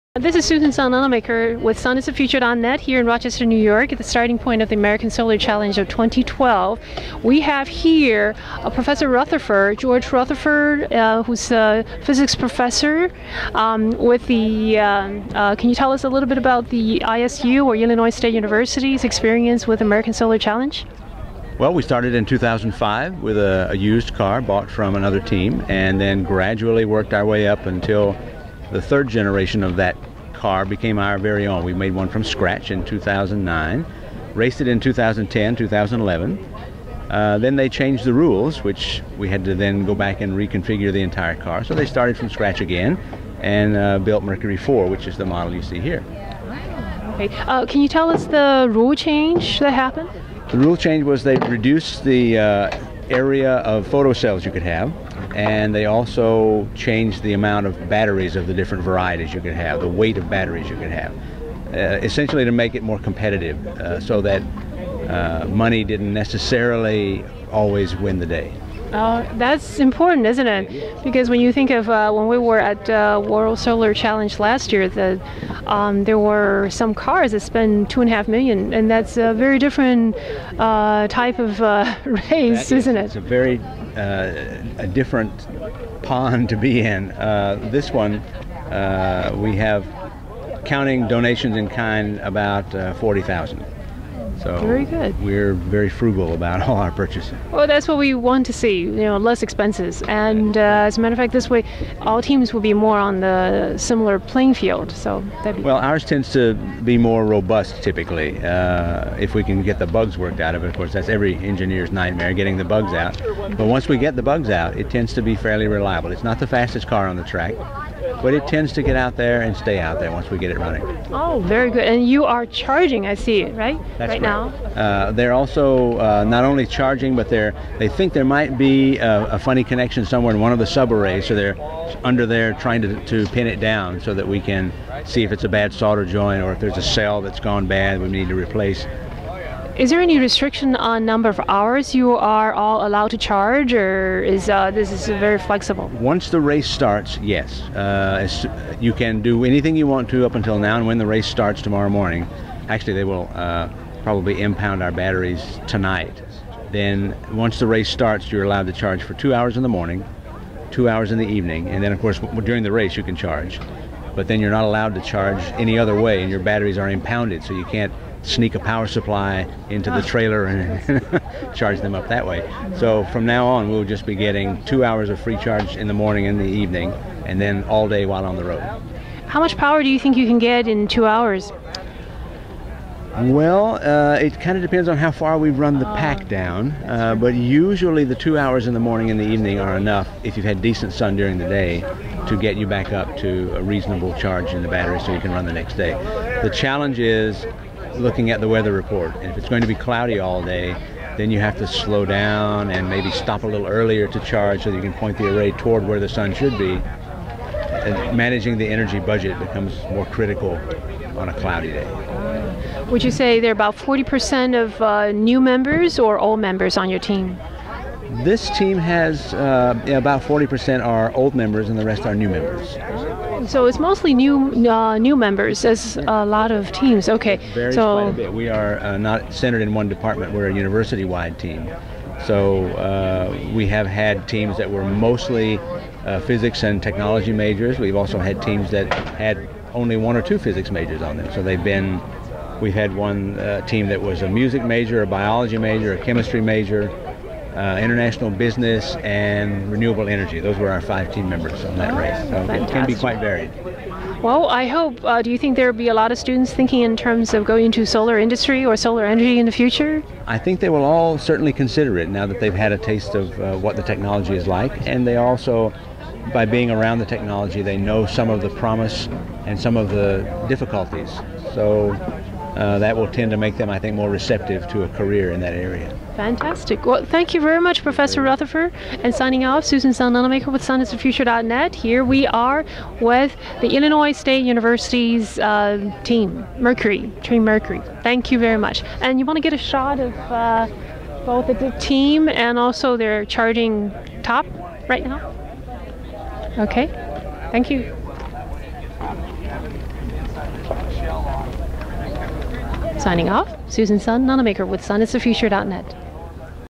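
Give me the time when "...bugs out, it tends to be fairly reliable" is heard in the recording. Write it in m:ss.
1:54.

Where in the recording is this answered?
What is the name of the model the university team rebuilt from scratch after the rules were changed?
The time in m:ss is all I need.
0:44.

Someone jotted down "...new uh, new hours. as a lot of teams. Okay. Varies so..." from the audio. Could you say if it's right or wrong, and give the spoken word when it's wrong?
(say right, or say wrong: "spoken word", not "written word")
wrong: "members", not "hours".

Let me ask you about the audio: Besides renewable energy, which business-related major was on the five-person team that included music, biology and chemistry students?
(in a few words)
International business.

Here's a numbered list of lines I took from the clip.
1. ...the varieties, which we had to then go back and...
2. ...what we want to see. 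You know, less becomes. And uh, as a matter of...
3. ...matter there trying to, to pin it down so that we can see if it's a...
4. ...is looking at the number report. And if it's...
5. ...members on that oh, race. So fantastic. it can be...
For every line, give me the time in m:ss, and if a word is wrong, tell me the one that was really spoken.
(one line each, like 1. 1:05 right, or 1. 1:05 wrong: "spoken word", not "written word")
1. 0:38 wrong: "rules", not "varieties"
2. 1:37 wrong: "expenses", not "becomes"
3. 2:12 wrong: "under", not "matter"
4. 3:16 wrong: "weather", not "number"
5. 4:11 right.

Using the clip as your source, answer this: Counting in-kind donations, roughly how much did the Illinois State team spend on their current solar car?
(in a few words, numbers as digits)
40,000.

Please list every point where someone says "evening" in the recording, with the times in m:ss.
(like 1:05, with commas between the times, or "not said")
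2:41, 2:56, 3:09.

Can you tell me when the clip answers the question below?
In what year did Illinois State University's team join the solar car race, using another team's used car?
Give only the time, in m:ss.
0:22.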